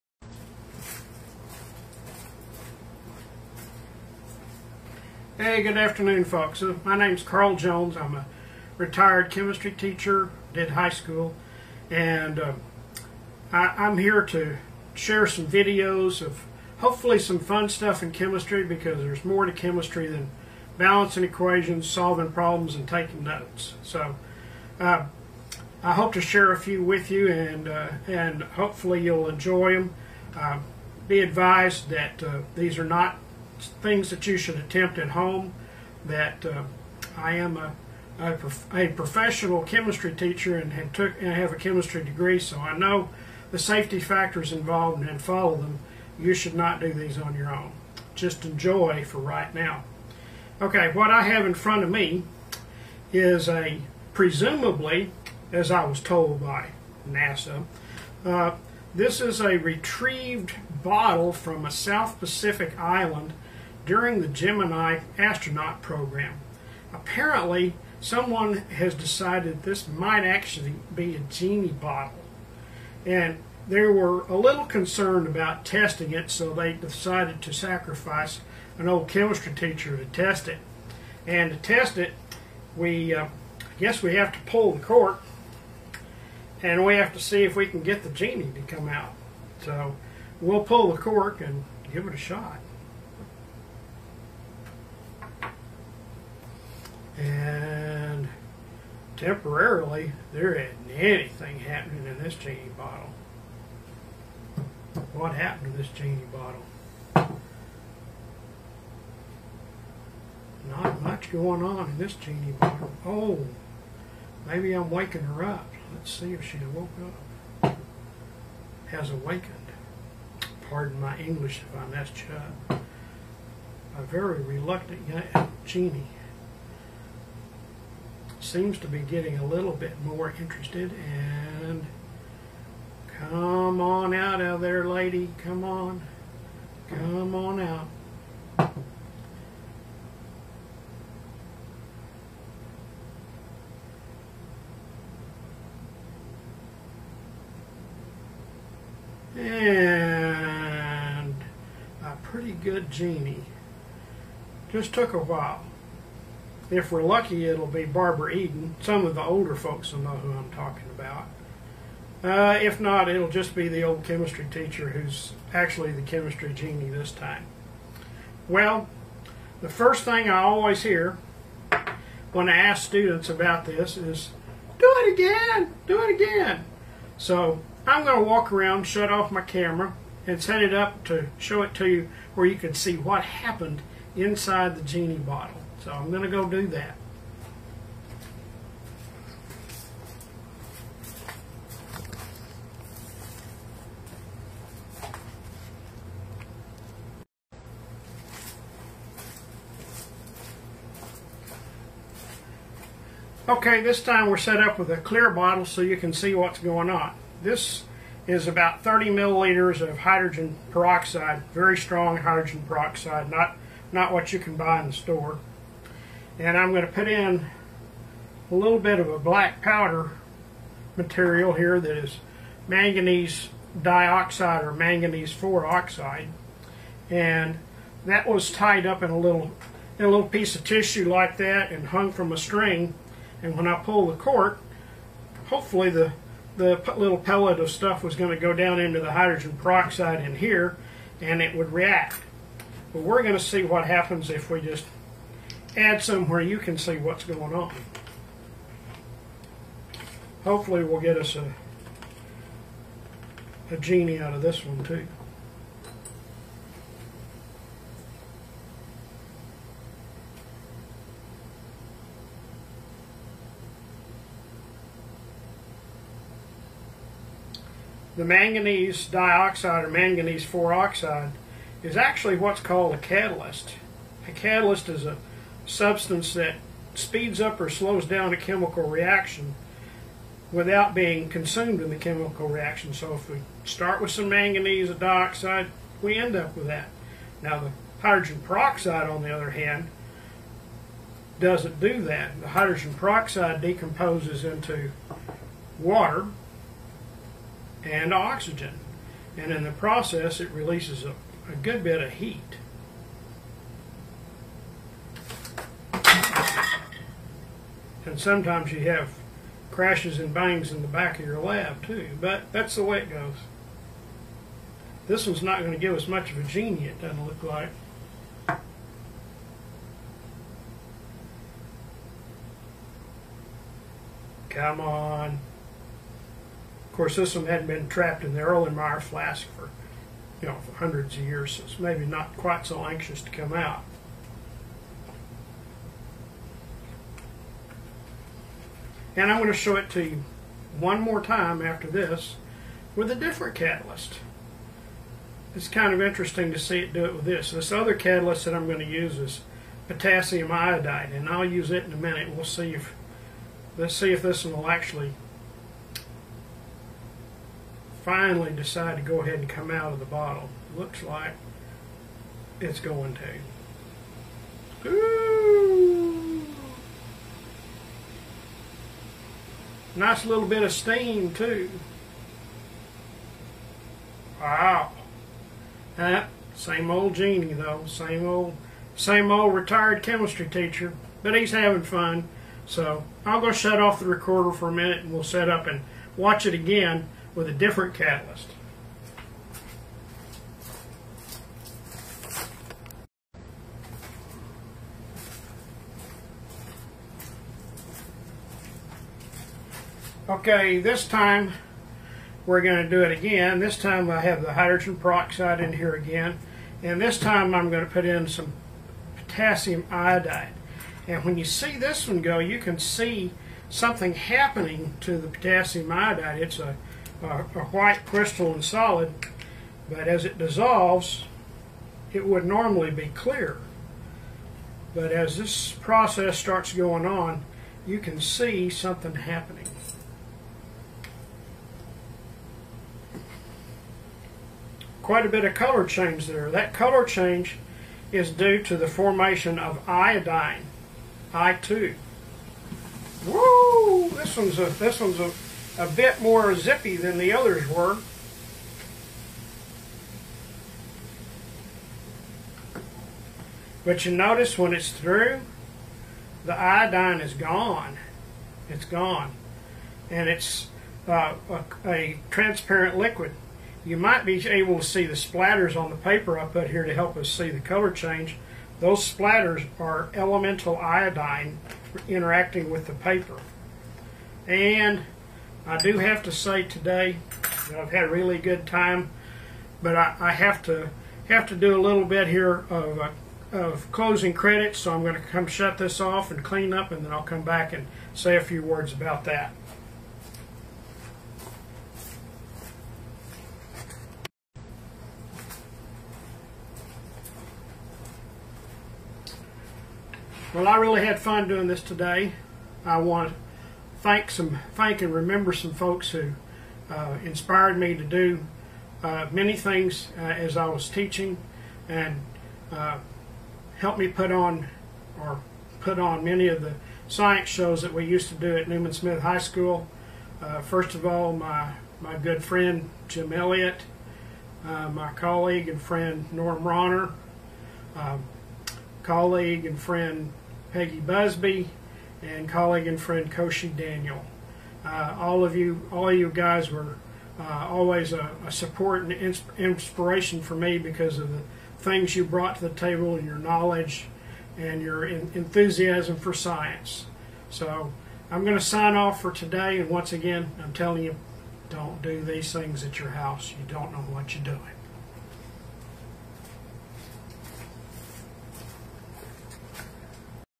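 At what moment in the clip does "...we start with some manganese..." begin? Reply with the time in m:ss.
4:43.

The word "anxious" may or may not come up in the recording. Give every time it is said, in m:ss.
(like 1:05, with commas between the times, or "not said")
5:32.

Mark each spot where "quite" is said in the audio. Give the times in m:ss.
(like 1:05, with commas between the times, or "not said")
5:32, 7:15.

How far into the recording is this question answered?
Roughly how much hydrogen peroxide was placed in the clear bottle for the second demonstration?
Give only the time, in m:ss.
3:28.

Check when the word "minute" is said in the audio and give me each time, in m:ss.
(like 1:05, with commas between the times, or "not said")
5:51, 6:24.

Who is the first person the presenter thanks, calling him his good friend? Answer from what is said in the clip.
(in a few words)
Jim Elliott.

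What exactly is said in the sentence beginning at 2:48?
Well, the first thing I always hear when I ask students about this is, do it again, do it again.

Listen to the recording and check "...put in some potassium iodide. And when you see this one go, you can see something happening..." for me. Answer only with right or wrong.
right.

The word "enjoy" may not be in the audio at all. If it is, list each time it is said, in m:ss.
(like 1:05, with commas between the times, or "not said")
0:29, 0:48.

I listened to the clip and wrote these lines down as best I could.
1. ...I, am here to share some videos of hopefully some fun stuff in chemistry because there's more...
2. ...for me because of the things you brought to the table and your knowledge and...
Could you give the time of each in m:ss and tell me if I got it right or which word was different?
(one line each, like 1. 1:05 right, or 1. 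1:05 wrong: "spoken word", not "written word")
1. 0:13 right
2. 9:00 right.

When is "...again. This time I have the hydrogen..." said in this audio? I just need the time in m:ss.
6:43.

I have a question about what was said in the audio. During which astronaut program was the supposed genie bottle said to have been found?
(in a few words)
Gemini.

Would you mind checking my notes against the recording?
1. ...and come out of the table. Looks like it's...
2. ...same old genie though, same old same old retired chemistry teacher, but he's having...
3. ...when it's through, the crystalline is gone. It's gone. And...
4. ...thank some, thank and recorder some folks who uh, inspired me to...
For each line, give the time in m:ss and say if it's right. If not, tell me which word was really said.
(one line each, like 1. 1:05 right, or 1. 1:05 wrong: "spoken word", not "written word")
1. 5:59 wrong: "bottle", not "table"
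2. 6:16 right
3. 7:34 wrong: "iodine", not "crystalline"
4. 8:24 wrong: "remember", not "recorder".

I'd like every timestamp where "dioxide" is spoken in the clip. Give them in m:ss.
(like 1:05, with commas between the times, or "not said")
3:43, 4:29, 4:44.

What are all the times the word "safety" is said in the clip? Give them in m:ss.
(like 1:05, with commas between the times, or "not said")
0:43.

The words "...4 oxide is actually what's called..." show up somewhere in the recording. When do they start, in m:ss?
4:30.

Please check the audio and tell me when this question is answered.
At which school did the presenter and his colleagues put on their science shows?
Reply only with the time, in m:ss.
8:38.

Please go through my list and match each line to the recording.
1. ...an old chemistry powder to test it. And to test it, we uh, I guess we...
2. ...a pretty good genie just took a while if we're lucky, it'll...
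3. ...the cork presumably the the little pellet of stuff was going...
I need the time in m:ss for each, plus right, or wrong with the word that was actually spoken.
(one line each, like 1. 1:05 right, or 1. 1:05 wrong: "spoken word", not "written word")
1. 1:18 wrong: "teacher", not "powder"
2. 2:32 right
3. 3:54 wrong: "hopefully", not "presumably".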